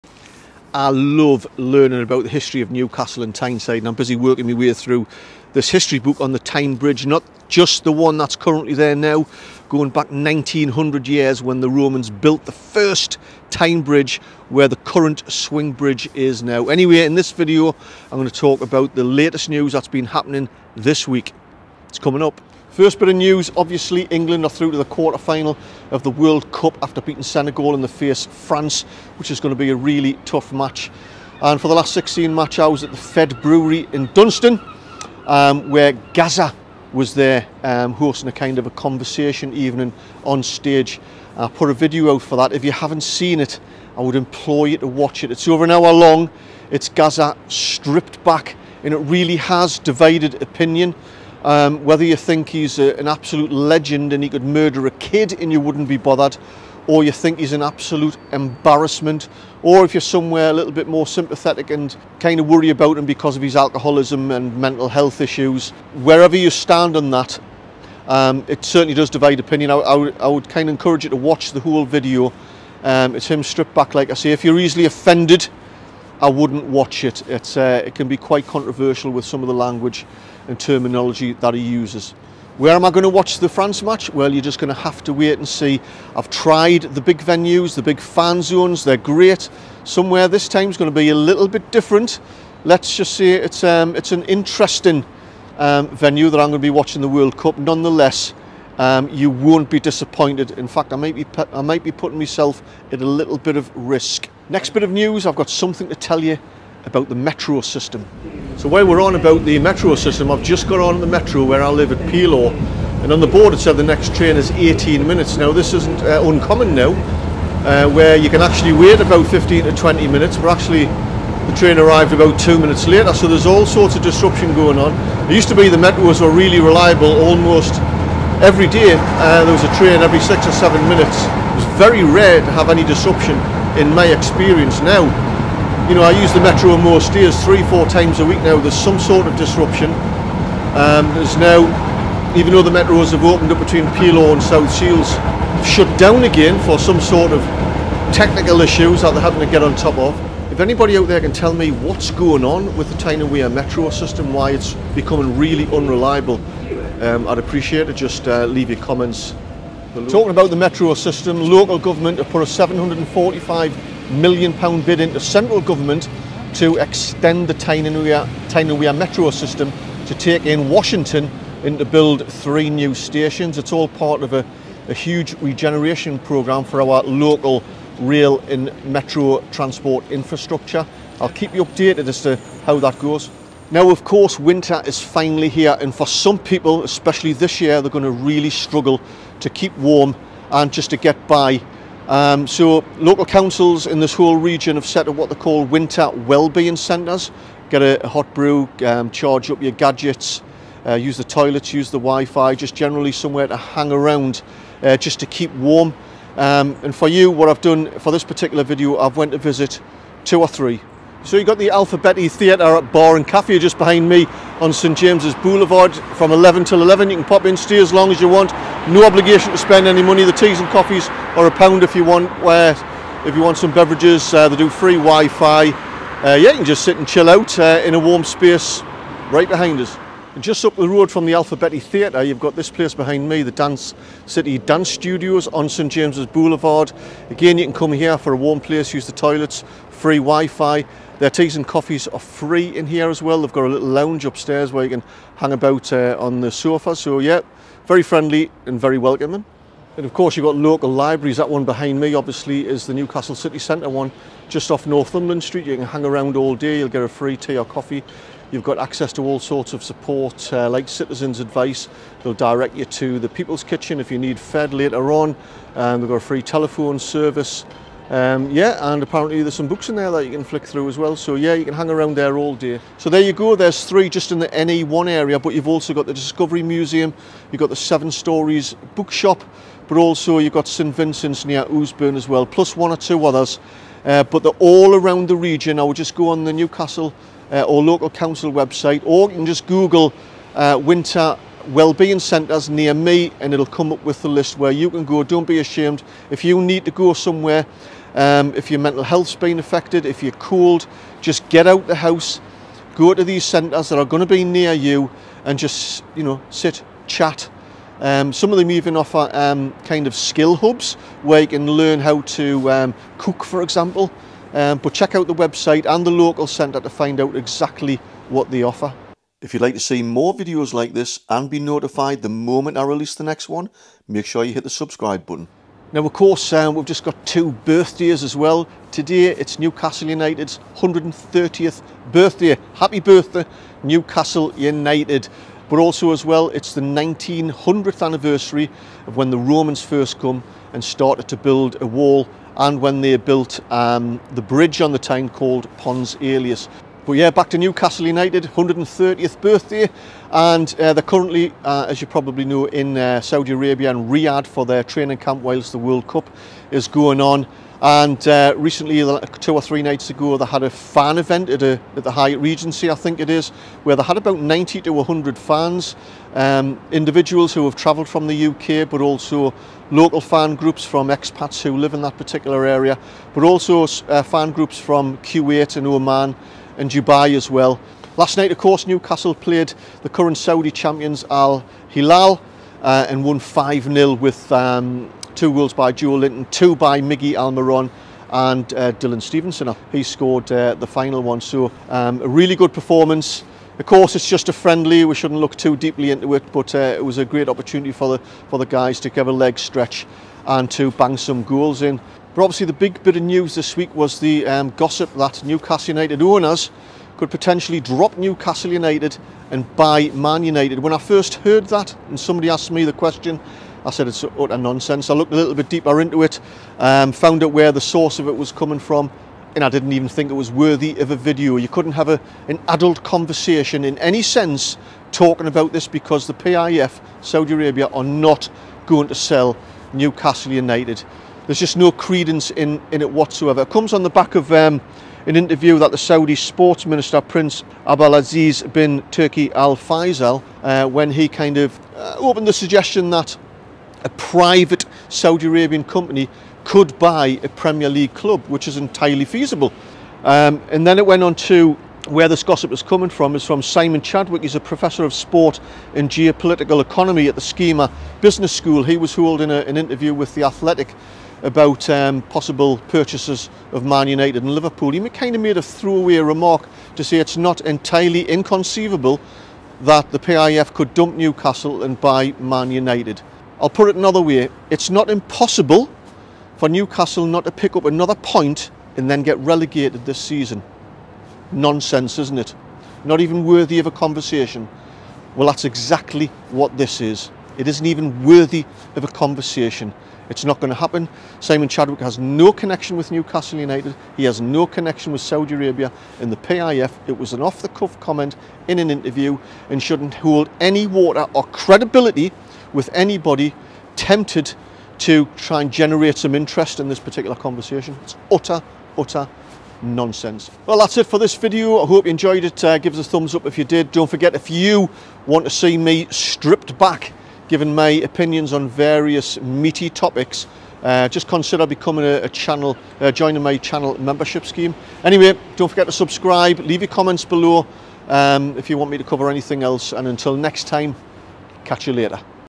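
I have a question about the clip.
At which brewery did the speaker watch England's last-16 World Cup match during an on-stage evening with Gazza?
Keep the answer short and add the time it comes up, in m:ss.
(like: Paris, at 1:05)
Fed Brewery, at 0:32.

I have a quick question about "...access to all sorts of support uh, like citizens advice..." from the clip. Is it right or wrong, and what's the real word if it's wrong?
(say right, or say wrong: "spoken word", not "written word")
right.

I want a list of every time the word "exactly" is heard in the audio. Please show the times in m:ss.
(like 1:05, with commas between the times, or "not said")
5:17, 8:05.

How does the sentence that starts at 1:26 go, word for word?
I've tried the big venues, the big fan zones, they're great.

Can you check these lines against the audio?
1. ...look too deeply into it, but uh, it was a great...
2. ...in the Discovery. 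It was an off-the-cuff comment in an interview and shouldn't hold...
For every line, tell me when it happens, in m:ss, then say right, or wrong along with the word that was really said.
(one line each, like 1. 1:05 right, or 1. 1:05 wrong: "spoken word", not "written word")
1. 6:35 right
2. 8:16 wrong: "PIF", not "Discovery".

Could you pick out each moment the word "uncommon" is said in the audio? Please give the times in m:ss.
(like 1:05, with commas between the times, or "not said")
1:56.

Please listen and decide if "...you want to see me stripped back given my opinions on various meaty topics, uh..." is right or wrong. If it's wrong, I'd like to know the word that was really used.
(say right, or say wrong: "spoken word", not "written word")
right.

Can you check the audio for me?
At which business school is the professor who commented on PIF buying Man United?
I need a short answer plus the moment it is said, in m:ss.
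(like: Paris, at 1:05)
SKEMA Business School, at 7:37.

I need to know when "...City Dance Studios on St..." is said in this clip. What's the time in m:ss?
3:54.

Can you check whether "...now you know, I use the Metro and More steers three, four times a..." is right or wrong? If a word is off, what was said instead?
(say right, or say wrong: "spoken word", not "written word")
right.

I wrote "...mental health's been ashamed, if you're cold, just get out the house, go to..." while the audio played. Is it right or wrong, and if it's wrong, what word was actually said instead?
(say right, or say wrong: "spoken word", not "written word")
wrong: "affected", not "ashamed".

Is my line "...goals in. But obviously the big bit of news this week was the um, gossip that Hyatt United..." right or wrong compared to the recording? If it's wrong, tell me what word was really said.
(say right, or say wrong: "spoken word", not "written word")
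wrong: "Newcastle", not "Hyatt".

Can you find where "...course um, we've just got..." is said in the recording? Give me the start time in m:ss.
5:26.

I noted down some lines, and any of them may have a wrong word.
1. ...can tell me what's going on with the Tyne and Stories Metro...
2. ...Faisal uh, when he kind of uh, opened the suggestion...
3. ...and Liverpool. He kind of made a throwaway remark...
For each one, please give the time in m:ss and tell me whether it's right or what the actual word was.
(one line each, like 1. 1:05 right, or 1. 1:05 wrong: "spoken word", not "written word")
1. 2:31 wrong: "Wear", not "Stories"
2. 7:19 right
3. 7:44 right.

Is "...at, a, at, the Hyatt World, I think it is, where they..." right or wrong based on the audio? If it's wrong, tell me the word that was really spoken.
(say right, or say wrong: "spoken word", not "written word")
wrong: "Regency", not "World".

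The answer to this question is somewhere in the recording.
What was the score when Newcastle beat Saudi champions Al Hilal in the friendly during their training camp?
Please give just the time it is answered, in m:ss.
6:23.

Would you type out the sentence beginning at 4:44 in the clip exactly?
Uh, but they're all around the region.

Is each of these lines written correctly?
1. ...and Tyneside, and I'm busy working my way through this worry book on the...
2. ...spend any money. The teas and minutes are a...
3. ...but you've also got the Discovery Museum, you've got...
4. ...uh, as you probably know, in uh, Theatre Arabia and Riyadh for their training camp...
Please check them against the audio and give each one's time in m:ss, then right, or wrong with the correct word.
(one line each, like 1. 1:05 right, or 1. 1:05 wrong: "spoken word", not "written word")
1. 0:03 wrong: "history", not "worry"
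2. 3:39 wrong: "coffees", not "minutes"
3. 4:35 right
4. 5:51 wrong: "Saudi", not "Theatre".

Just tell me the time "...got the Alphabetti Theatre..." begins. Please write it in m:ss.
3:31.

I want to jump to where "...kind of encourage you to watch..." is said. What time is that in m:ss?
1:10.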